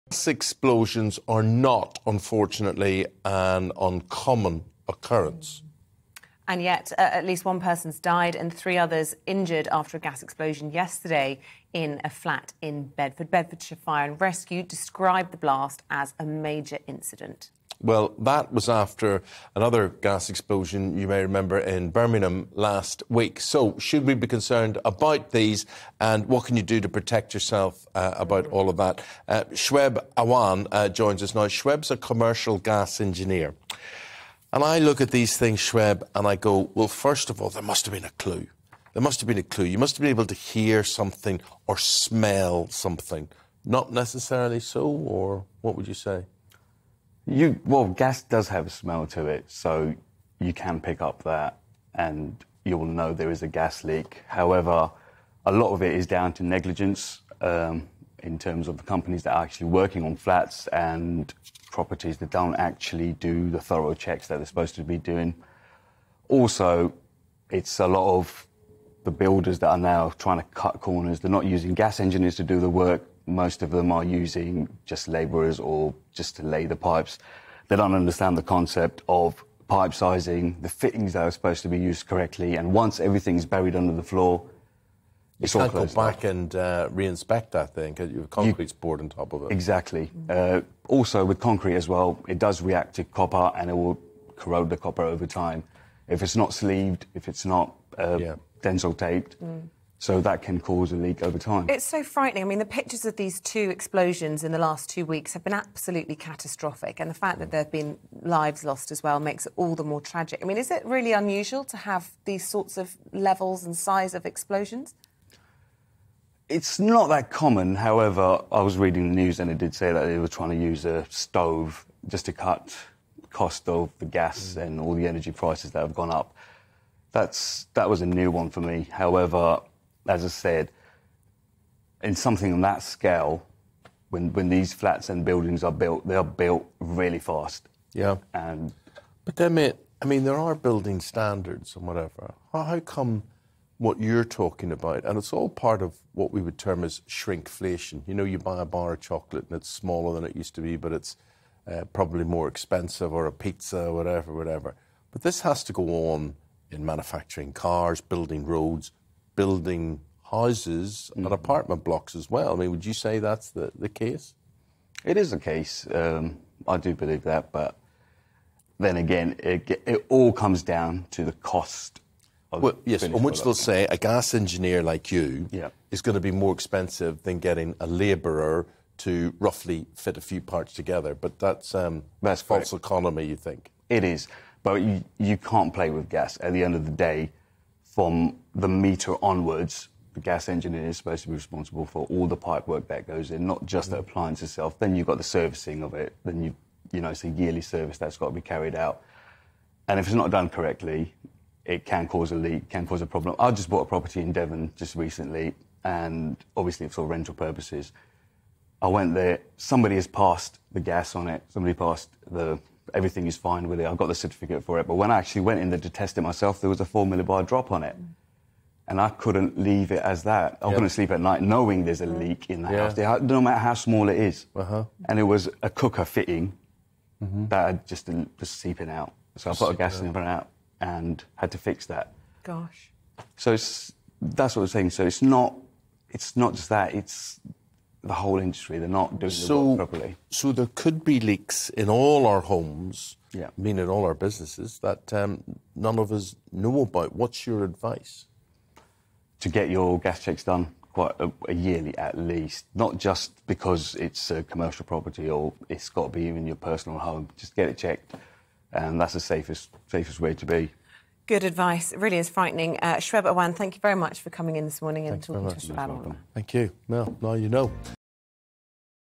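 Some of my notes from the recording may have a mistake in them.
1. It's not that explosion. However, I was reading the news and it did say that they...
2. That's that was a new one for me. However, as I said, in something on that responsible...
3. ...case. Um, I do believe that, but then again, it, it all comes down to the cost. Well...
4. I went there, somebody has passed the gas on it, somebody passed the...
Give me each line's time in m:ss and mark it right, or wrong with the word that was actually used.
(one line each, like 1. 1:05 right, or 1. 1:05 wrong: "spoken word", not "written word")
1. 1:56 wrong: "common", not "explosion"
2. 2:07 wrong: "scale", not "responsible"
3. 2:45 right
4. 3:28 right.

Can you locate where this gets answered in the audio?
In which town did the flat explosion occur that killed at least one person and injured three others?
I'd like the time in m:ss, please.
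0:12.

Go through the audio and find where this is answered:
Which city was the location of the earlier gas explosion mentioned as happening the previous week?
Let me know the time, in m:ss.
0:21.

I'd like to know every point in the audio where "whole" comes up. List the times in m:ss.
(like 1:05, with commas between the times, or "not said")
3:58.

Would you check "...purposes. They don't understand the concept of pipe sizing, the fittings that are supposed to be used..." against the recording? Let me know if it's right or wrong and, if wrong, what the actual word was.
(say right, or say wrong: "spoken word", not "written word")
wrong: "pipes", not "purposes".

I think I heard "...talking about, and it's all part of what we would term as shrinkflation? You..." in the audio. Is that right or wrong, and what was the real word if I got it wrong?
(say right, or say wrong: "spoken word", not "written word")
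right.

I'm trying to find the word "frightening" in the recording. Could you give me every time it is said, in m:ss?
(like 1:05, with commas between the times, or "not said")
1:42, 4:22.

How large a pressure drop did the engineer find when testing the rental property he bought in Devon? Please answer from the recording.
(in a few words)
4 millibar.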